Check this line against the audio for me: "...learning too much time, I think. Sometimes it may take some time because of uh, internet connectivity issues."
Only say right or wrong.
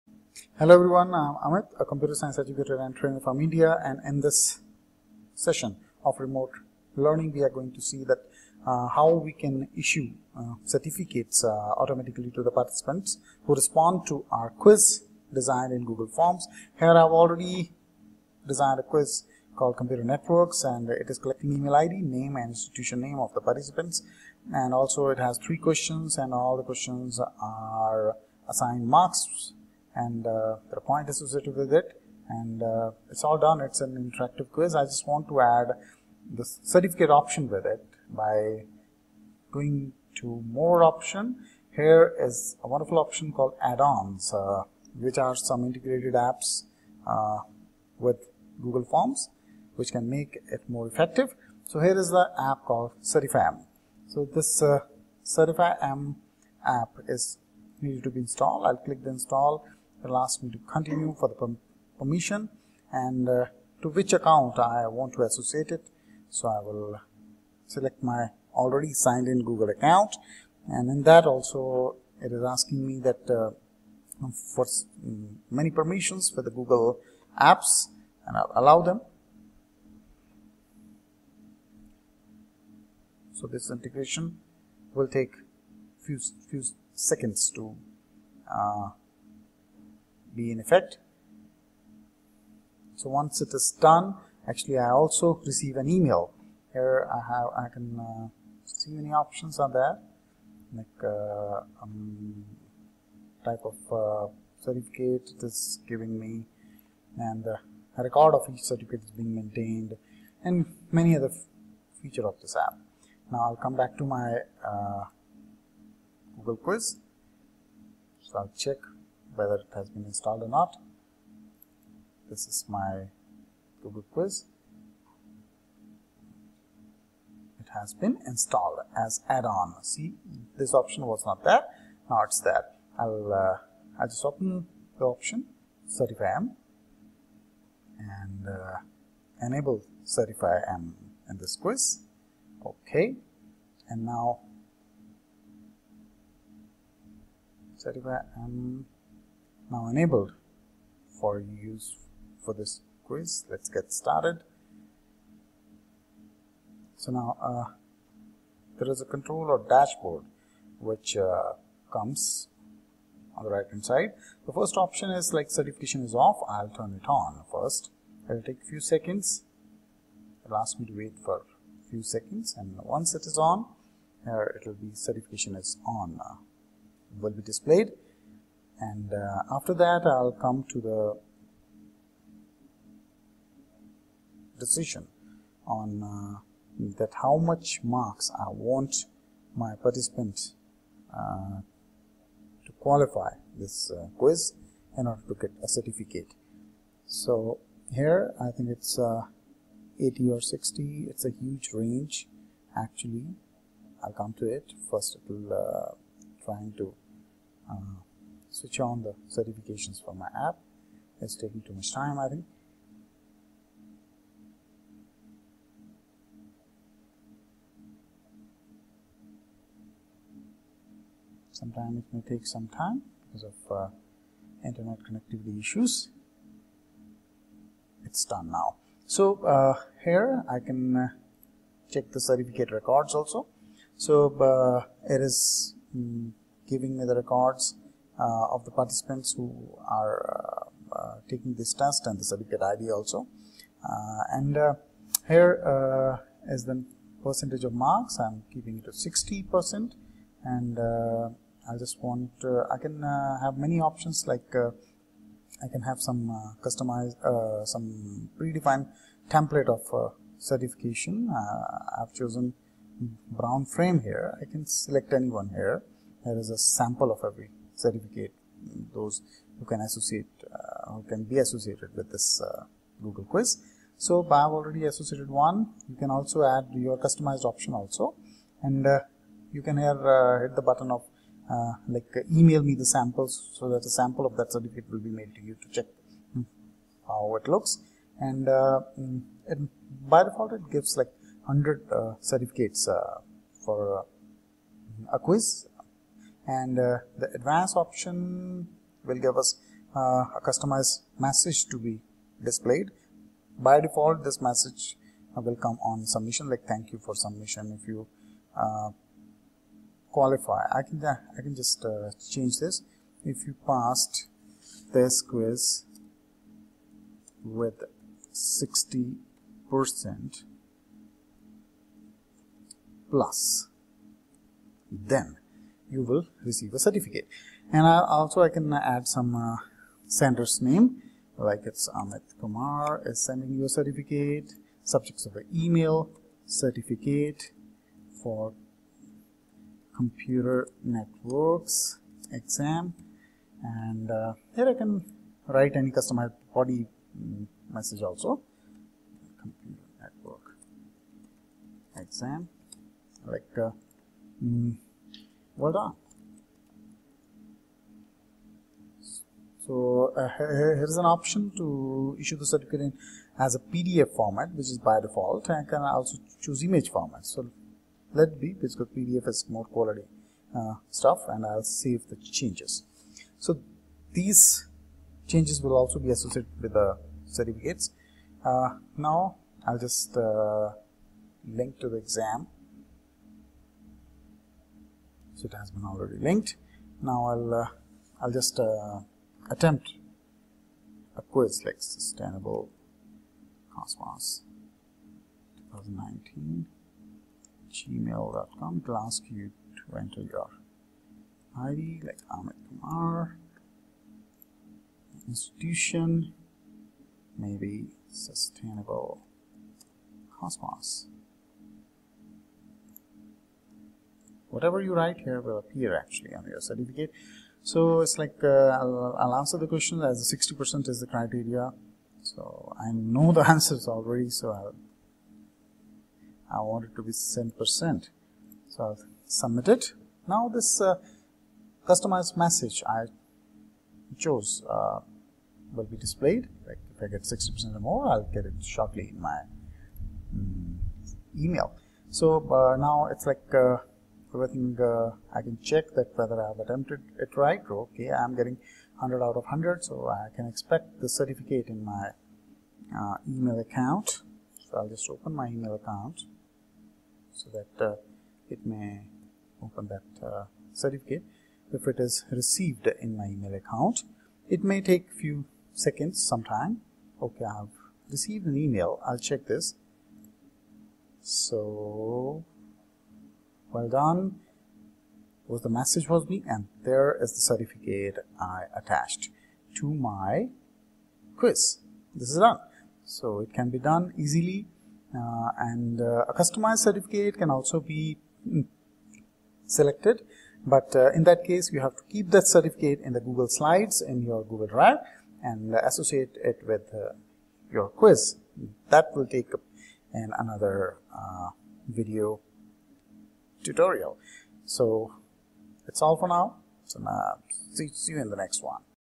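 wrong.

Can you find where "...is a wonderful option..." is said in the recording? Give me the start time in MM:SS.
00:42.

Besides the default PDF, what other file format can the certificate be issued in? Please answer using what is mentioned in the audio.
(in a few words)
image.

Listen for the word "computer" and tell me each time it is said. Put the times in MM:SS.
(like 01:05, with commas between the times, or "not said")
00:01, 00:19, 05:39, 05:49.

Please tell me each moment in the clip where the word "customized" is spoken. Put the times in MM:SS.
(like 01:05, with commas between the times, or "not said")
04:16, 04:36, 05:00, 05:45, 07:11, 08:06.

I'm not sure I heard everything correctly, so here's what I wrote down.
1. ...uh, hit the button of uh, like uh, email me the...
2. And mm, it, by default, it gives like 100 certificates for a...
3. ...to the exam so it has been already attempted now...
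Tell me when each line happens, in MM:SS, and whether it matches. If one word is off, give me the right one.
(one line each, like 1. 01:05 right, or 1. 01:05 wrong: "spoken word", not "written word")
1. 04:40 right
2. 04:48 right
3. 06:21 wrong: "linked", not "attempted".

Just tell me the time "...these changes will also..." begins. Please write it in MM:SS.
06:14.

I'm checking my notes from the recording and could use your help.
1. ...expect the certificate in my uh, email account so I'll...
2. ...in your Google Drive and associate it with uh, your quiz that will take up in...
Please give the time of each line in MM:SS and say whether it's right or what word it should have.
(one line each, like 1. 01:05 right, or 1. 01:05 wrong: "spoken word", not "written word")
1. 07:30 right
2. 08:14 right.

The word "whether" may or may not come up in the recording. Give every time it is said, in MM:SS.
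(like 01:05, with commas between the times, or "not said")
01:59, 07:26.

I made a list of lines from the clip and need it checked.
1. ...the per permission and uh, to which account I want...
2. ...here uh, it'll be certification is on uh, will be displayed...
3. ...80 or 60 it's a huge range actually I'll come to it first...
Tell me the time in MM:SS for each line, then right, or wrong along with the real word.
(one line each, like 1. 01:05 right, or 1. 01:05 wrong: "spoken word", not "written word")
1. 01:01 right
2. 02:54 right
3. 03:19 right.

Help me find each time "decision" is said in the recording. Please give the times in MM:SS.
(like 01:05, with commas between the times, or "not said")
03:04.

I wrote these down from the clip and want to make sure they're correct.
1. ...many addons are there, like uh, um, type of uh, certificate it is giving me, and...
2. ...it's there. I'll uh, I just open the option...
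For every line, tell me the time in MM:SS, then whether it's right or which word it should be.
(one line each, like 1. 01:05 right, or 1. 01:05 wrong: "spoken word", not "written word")
1. 01:38 wrong: "options", not "addons"
2. 02:12 right.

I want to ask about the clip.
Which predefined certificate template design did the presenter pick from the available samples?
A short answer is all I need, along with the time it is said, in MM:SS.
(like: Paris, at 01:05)
brown frame, at 04:23.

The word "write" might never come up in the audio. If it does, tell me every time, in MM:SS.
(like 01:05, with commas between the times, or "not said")
05:45, 06:54.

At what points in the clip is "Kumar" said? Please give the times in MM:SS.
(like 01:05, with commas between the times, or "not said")
05:32, 06:42.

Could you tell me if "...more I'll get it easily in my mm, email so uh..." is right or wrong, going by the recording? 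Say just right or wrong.
wrong.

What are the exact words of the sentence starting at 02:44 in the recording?
The first option is like certification is off.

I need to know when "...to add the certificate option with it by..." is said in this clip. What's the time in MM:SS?
00:35.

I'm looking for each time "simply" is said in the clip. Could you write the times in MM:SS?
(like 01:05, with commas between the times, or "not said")
not said.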